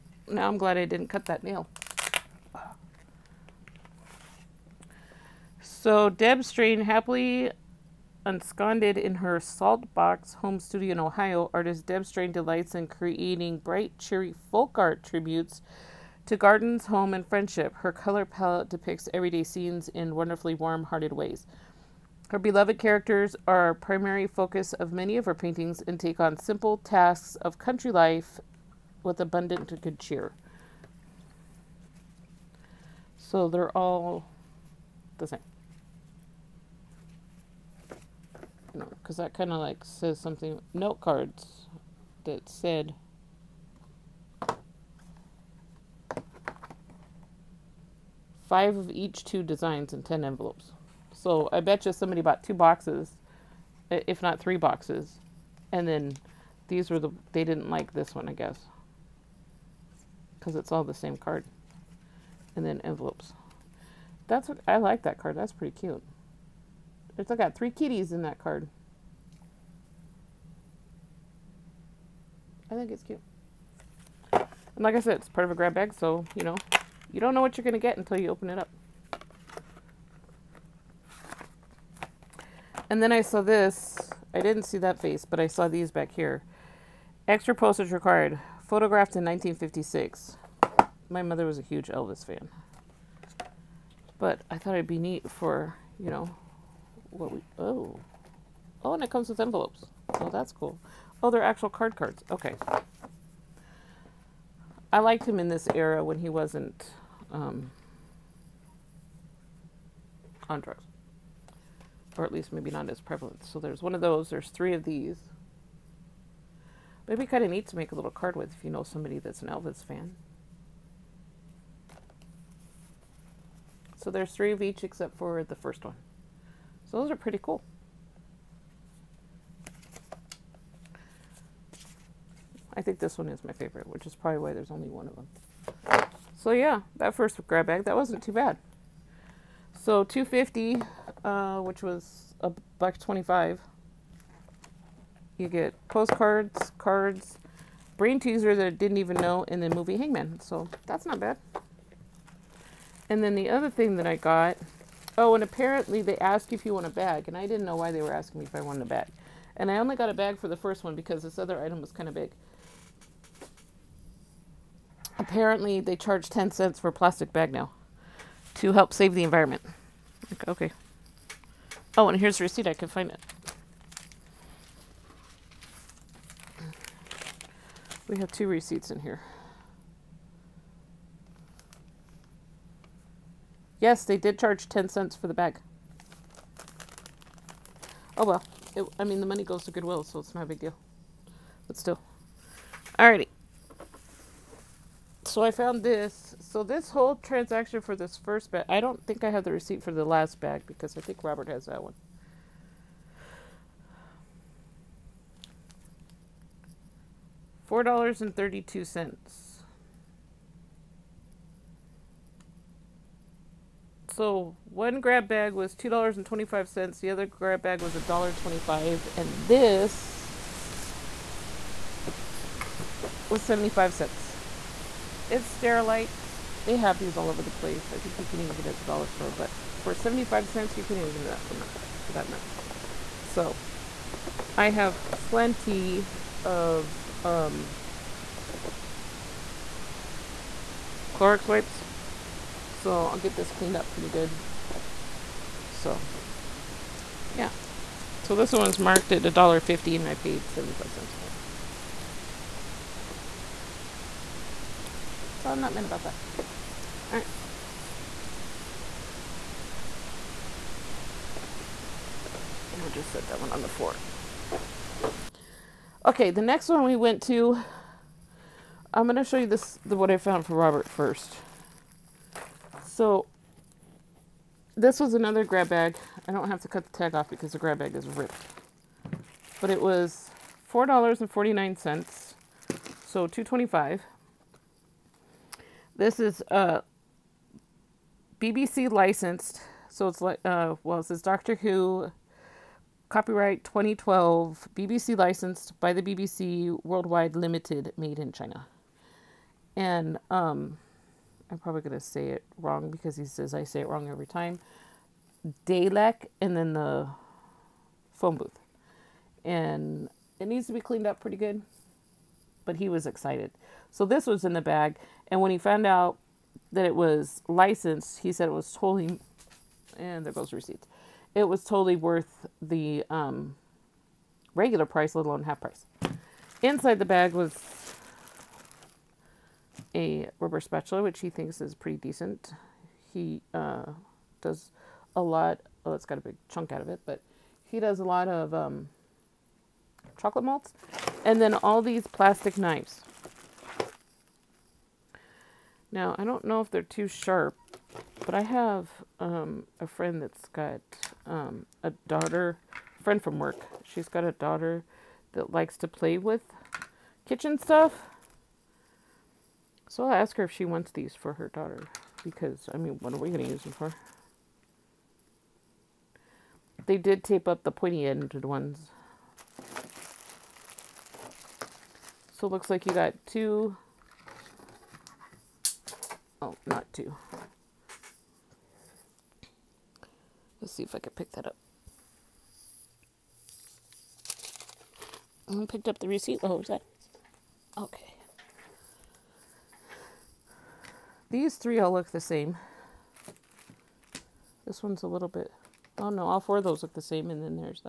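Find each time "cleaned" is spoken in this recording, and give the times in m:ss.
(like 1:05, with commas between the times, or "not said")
4:03, 5:10.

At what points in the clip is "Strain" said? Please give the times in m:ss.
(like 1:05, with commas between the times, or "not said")
0:06, 0:12.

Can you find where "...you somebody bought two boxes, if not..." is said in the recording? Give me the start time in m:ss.
0:51.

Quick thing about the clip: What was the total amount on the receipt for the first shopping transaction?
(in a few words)
$4.32.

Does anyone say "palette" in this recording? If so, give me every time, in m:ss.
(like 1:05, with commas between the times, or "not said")
0:18.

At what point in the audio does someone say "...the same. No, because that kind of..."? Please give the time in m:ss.
0:35.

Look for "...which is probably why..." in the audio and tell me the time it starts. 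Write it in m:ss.
2:13.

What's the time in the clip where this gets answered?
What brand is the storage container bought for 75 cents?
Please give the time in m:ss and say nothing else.
3:45.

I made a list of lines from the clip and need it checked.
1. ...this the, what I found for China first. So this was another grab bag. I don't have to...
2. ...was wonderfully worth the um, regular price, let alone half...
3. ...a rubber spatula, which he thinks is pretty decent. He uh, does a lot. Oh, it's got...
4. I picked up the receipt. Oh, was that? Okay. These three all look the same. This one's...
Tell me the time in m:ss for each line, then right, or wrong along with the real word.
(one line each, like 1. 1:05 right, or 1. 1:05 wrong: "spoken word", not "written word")
1. 4:29 wrong: "Robert", not "China"
2. 5:21 wrong: "totally", not "wonderfully"
3. 5:29 right
4. 6:25 right.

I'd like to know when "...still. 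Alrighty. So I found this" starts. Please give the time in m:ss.
3:11.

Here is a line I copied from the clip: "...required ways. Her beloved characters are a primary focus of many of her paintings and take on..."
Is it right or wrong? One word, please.
wrong.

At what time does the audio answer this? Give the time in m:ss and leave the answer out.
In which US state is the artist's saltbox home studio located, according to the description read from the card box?
0:10.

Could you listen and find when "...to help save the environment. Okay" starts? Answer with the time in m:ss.
2:48.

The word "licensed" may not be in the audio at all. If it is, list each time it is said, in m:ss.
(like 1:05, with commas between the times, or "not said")
4:48, 4:55, 5:17.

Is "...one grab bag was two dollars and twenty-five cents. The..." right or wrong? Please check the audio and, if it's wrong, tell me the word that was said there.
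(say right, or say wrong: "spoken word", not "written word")
right.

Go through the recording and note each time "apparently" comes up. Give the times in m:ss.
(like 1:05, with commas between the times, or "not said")
2:35, 2:45.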